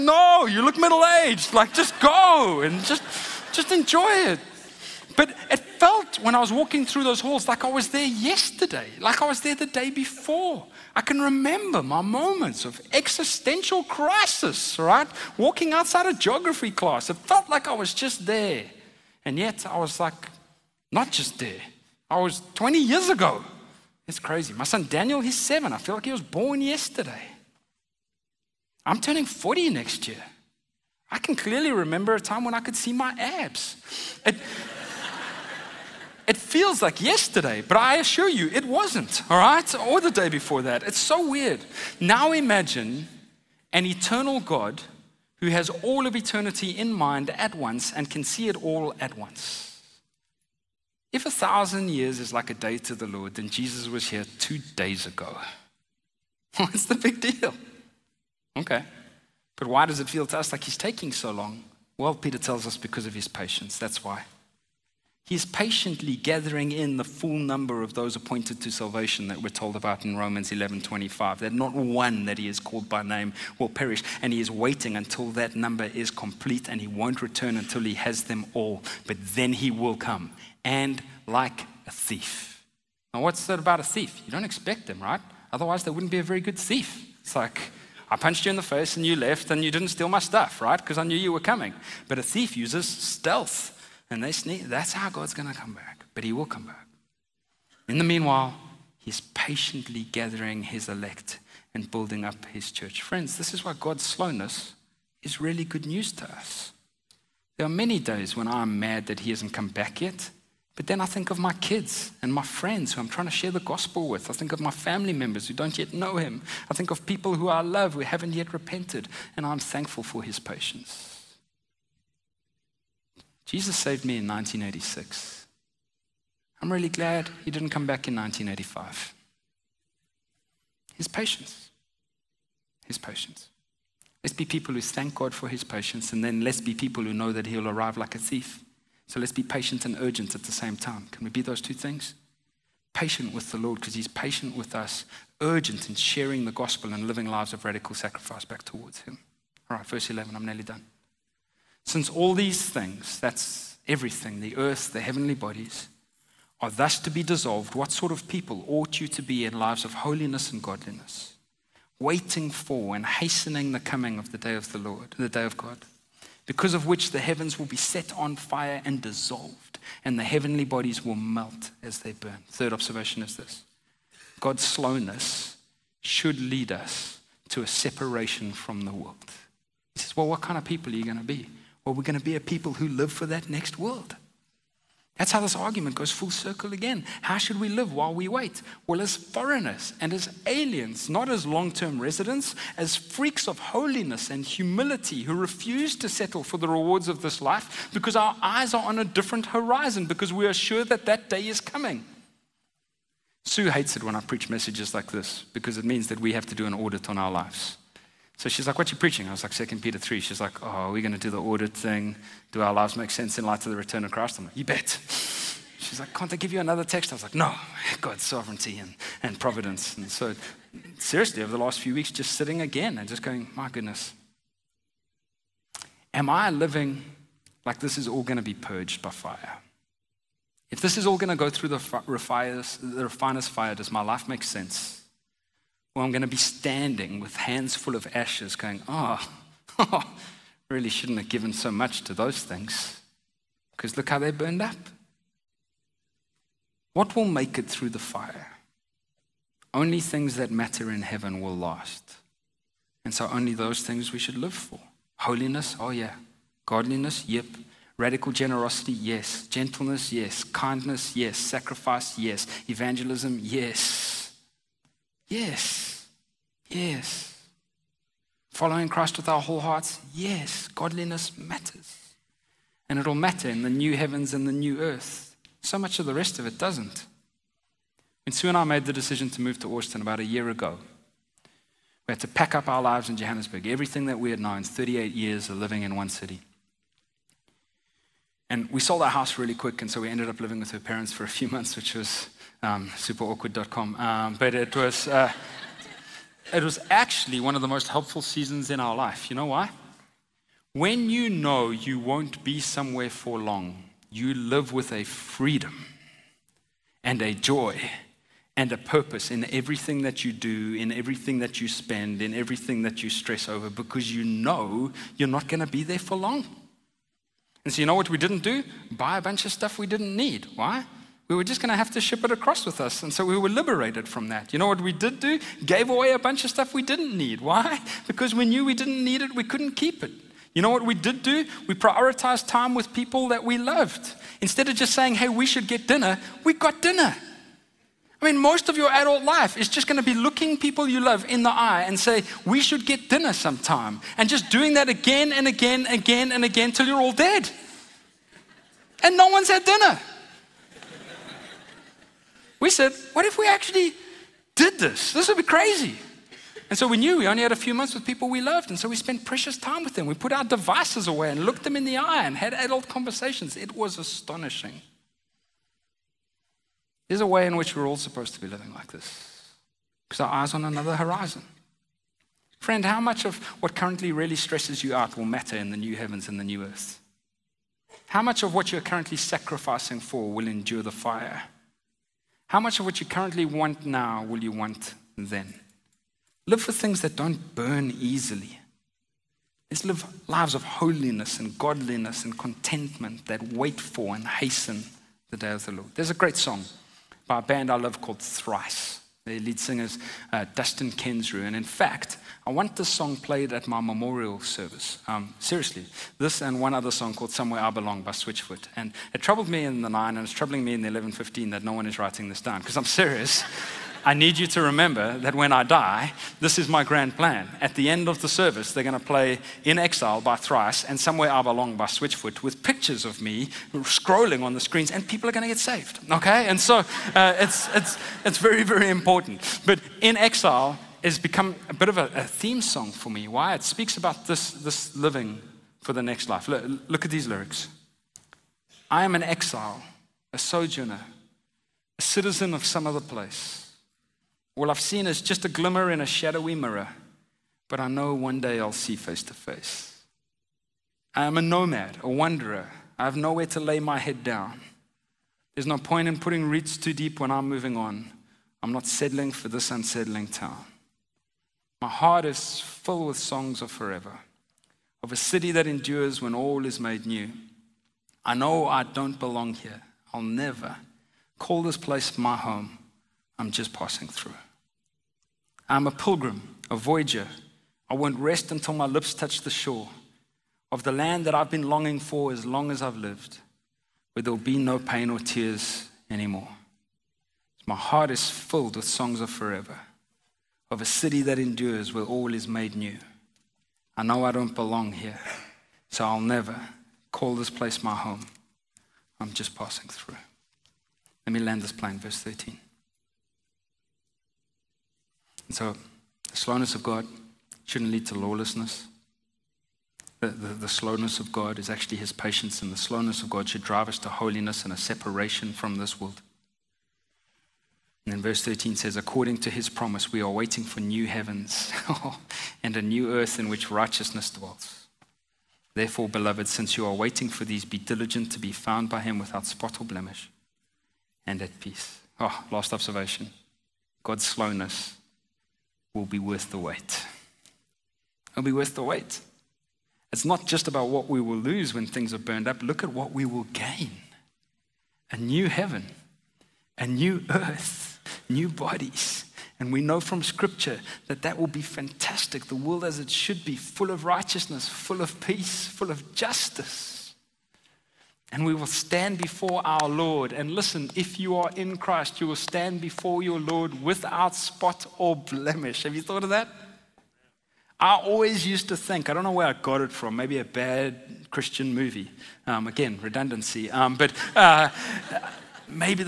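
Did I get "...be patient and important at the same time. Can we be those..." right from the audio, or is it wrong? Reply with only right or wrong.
wrong.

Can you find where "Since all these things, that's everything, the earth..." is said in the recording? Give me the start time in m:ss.
2:31.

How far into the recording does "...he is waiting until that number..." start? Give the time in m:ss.
1:14.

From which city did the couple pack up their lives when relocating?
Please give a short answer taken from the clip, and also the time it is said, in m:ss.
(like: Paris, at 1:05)
Johannesburg, at 4:43.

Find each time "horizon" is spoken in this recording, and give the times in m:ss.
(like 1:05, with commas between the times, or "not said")
3:19, 6:10.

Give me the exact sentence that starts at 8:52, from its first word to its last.
Oh, last observation God's slowness will be worth the wait.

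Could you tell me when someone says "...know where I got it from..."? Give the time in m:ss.
9:29.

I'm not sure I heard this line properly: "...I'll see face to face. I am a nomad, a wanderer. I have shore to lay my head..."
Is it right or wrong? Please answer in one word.
wrong.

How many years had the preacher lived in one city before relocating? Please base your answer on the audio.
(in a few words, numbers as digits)
38.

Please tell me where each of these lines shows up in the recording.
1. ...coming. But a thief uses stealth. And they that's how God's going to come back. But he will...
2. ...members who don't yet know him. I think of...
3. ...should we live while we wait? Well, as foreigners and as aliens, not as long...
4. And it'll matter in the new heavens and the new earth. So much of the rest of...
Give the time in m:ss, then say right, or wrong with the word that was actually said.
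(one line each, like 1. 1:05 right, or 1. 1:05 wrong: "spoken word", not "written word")
1. 1:31 right
2. 1:55 right
3. 3:07 right
4. 4:32 right.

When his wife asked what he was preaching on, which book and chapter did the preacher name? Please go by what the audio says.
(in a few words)
Second Peter 3.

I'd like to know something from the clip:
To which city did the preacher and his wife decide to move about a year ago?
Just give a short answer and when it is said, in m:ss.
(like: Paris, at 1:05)
Austin, at 4:39.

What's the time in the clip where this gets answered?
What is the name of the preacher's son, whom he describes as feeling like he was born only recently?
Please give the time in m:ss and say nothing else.
0:24.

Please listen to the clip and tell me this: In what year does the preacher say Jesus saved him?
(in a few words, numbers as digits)
1986.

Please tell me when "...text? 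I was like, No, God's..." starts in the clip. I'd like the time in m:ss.
3:36.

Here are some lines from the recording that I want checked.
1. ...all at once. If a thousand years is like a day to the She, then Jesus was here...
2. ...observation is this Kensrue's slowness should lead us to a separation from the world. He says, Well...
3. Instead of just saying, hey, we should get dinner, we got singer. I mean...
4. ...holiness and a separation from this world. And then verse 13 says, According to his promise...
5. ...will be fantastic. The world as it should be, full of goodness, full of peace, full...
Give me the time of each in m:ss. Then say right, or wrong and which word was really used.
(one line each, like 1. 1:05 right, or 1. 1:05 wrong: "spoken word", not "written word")
1. 0:48 wrong: "Lord", not "She"
2. 2:52 wrong: "God", not "Kensrue"
3. 5:34 wrong: "dinner", not "singer"
4. 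8:34 right
5. 9:11 wrong: "righteousness", not "goodness".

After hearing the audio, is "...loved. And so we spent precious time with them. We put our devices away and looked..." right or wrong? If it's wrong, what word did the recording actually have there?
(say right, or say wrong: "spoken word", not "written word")
right.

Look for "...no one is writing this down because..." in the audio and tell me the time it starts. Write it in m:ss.
6:51.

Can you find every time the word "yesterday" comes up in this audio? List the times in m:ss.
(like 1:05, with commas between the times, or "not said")
0:08, 0:26, 0:37.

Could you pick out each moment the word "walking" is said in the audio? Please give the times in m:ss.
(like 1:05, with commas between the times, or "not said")
0:06, 0:15.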